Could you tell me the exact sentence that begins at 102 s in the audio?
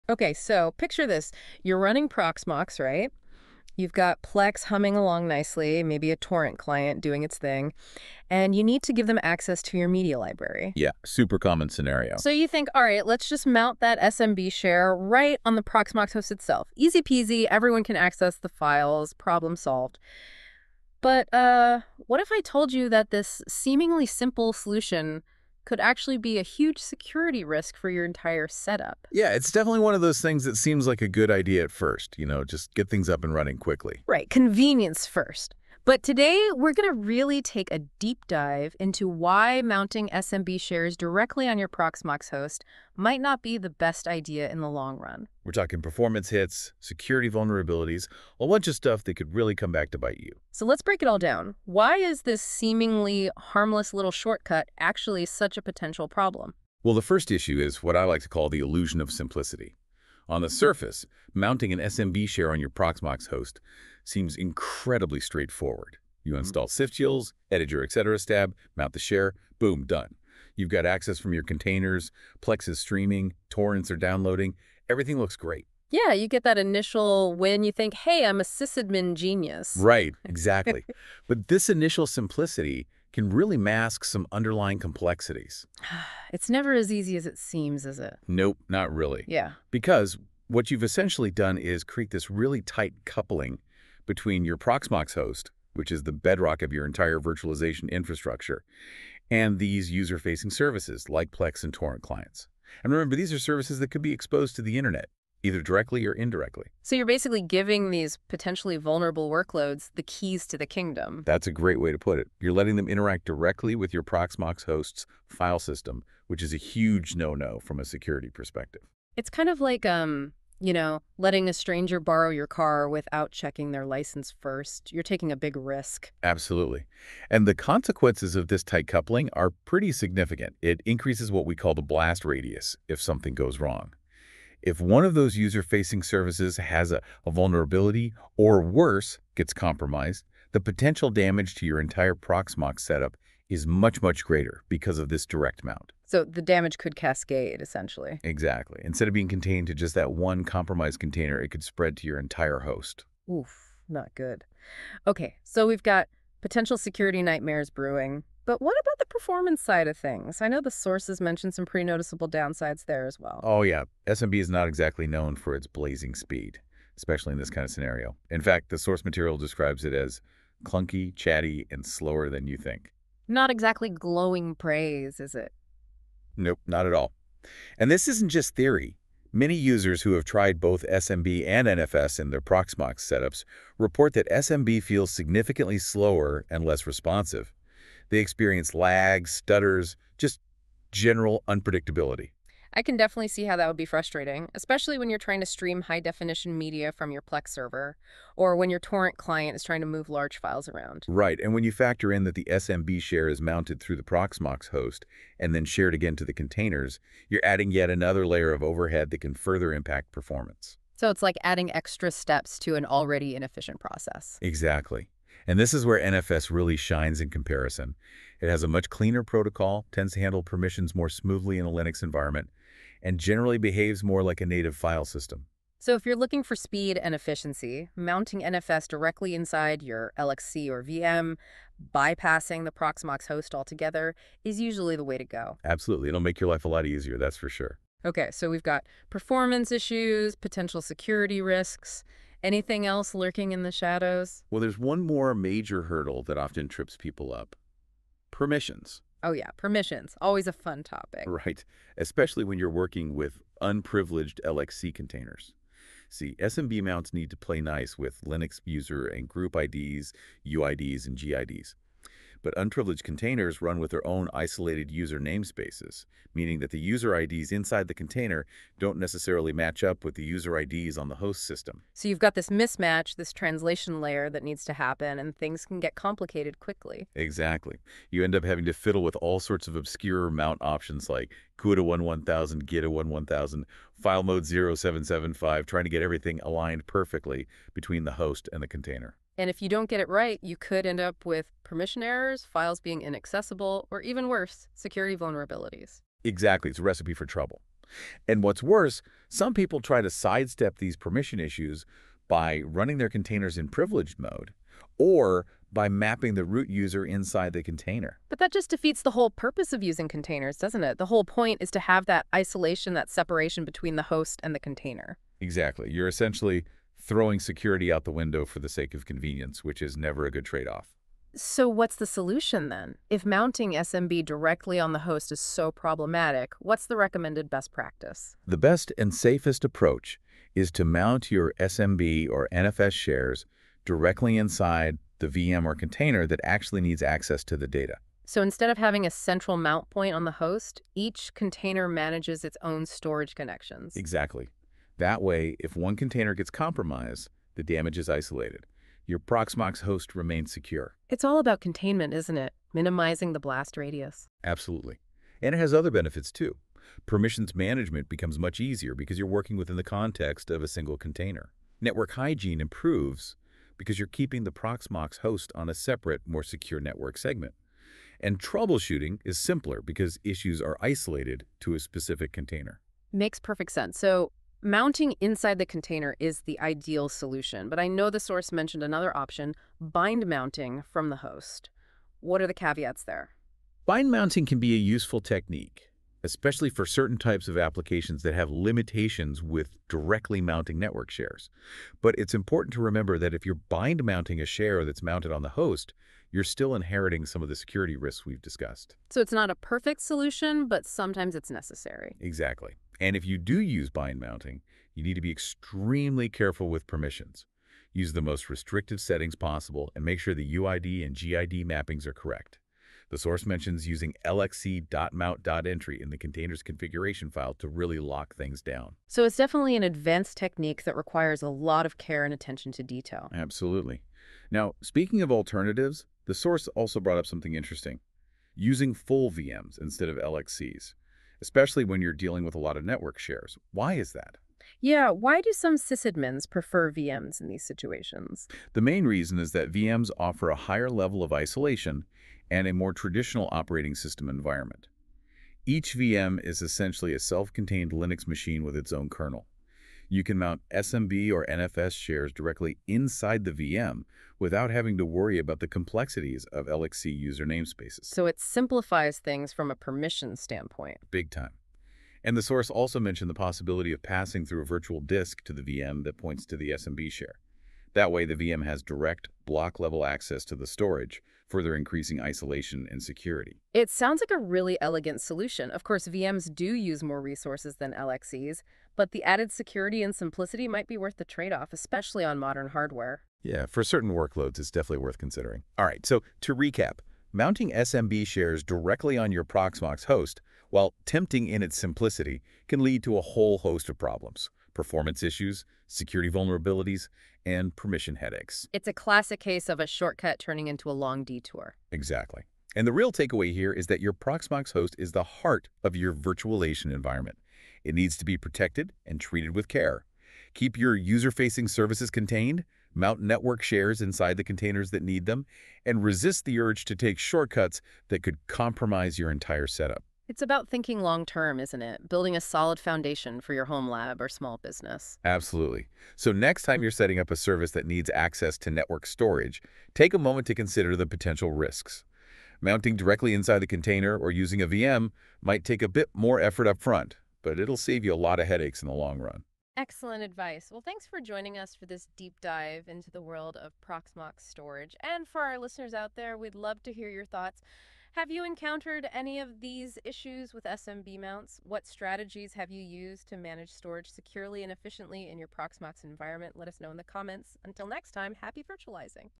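And remember, these are services that could be exposed to the internet, either directly or indirectly.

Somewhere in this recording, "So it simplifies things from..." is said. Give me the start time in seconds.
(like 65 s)
458 s.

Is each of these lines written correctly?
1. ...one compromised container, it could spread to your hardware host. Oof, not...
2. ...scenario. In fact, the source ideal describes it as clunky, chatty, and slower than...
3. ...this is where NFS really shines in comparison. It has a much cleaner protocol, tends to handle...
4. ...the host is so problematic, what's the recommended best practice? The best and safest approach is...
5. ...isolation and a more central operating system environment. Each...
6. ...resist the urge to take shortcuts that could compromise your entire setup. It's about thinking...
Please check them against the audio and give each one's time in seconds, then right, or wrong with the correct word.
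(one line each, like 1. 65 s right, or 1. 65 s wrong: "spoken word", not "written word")
1. 150 s wrong: "entire", not "hardware"
2. 167 s wrong: "material", not "ideal"
3. 215 s right
4. 324 s right
5. 441 s wrong: "traditional", not "central"
6. 516 s right.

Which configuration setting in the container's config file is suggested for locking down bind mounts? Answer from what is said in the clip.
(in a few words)
lxc.mount.entry.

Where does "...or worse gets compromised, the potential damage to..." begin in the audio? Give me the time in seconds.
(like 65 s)
138 s.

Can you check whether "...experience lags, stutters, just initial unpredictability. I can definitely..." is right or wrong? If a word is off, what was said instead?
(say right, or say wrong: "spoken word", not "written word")
wrong: "general", not "initial".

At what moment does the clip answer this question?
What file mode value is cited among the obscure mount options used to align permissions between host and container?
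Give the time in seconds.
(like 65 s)
284 s.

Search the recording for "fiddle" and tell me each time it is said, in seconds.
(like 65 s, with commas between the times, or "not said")
278 s.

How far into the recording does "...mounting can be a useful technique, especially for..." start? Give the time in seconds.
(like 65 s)
384 s.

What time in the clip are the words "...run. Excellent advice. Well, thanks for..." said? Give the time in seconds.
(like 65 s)
539 s.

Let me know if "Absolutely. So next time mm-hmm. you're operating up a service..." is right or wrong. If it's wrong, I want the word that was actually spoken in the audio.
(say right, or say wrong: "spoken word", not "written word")
wrong: "setting", not "operating".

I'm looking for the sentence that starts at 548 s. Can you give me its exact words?
Have you encountered any of these issues with SMB mounts?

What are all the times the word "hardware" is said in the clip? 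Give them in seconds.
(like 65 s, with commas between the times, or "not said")
482 s.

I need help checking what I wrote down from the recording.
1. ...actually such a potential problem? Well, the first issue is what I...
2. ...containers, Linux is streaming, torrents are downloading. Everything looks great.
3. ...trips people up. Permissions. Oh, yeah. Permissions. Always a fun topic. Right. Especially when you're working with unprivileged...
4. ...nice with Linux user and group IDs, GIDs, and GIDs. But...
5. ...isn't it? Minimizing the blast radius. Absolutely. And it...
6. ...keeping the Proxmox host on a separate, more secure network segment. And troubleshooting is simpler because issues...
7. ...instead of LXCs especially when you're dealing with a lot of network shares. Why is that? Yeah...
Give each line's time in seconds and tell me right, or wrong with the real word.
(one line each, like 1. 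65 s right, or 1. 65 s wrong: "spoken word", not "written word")
1. 54 s right
2. 71 s wrong: "Plex", not "Linux"
3. 246 s right
4. 257 s wrong: "UIDs", not "GIDs"
5. 352 s right
6. 364 s right
7. 429 s right.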